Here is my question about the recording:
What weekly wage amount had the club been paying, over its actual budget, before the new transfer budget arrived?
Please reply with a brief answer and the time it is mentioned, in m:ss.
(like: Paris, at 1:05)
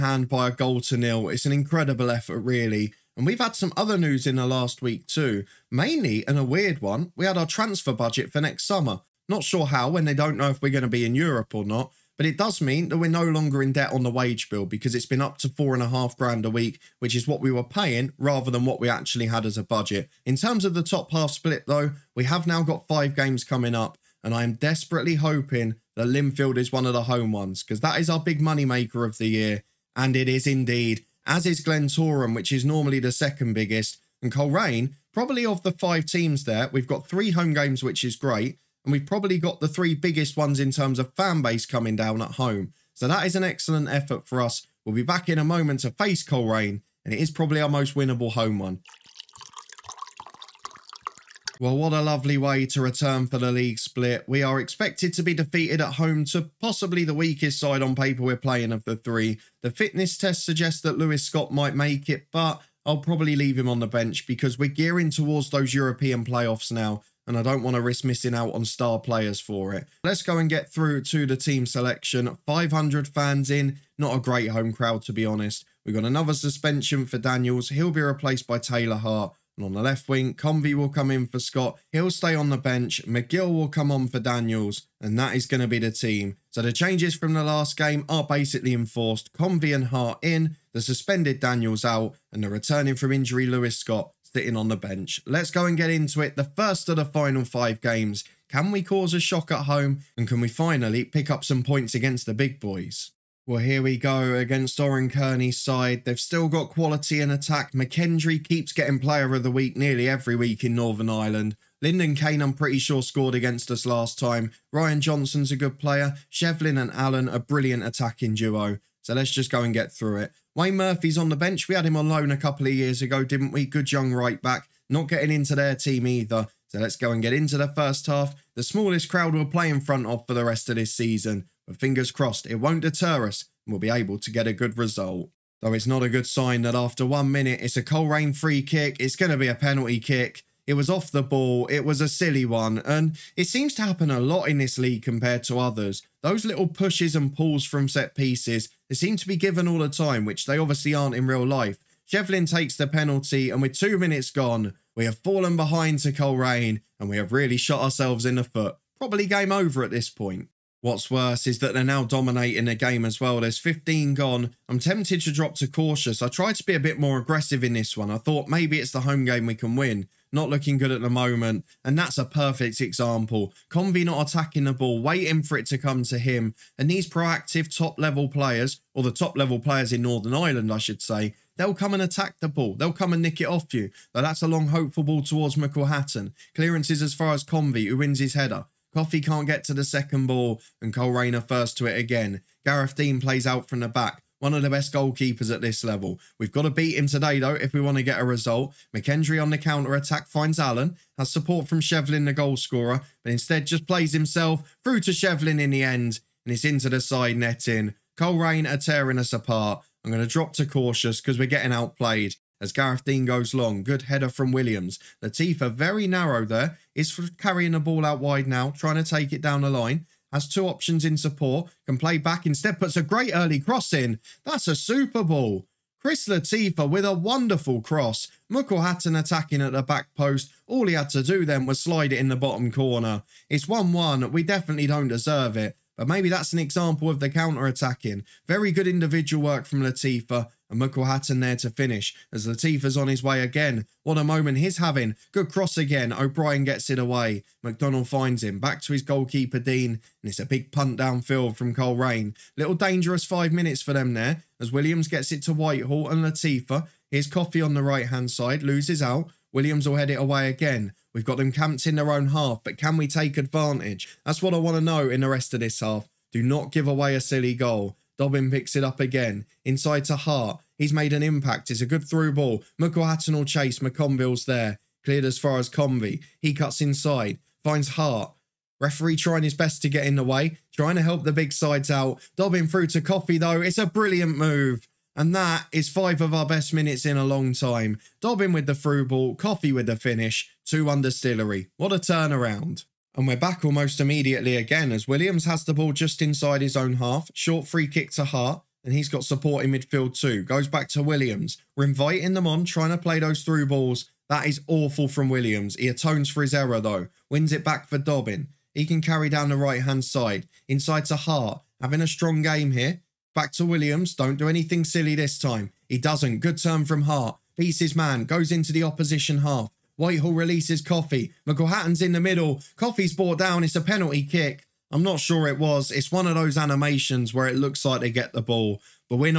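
£4,500, at 0:15.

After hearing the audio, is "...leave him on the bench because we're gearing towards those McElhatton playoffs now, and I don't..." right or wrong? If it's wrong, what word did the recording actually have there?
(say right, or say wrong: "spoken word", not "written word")
wrong: "European", not "McElhatton".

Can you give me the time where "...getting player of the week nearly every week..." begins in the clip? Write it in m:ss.
1:48.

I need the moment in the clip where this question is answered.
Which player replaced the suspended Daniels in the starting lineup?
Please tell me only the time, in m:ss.
1:18.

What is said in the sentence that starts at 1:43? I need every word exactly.
Well, here we go against Oran Kearney's side.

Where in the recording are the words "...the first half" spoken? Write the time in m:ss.
2:07.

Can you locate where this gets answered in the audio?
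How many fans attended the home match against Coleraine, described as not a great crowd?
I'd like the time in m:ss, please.
1:12.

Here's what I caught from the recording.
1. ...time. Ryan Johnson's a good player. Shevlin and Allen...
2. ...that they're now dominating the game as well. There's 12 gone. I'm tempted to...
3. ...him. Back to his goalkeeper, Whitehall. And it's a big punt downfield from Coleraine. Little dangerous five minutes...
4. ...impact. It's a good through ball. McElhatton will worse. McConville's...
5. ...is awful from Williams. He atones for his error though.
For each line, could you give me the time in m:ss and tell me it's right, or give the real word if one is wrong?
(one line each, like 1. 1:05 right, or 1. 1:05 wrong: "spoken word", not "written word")
1. 1:54 right
2. 2:41 wrong: "15", not "12"
3. 4:08 wrong: "Dean", not "Whitehall"
4. 4:31 wrong: "chase", not "worse"
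5. 5:04 right.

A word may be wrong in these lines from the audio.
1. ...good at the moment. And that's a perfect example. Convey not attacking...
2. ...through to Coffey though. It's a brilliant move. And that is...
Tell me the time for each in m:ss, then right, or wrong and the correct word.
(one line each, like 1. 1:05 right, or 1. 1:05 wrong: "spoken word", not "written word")
1. 2:50 right
2. 4:42 right.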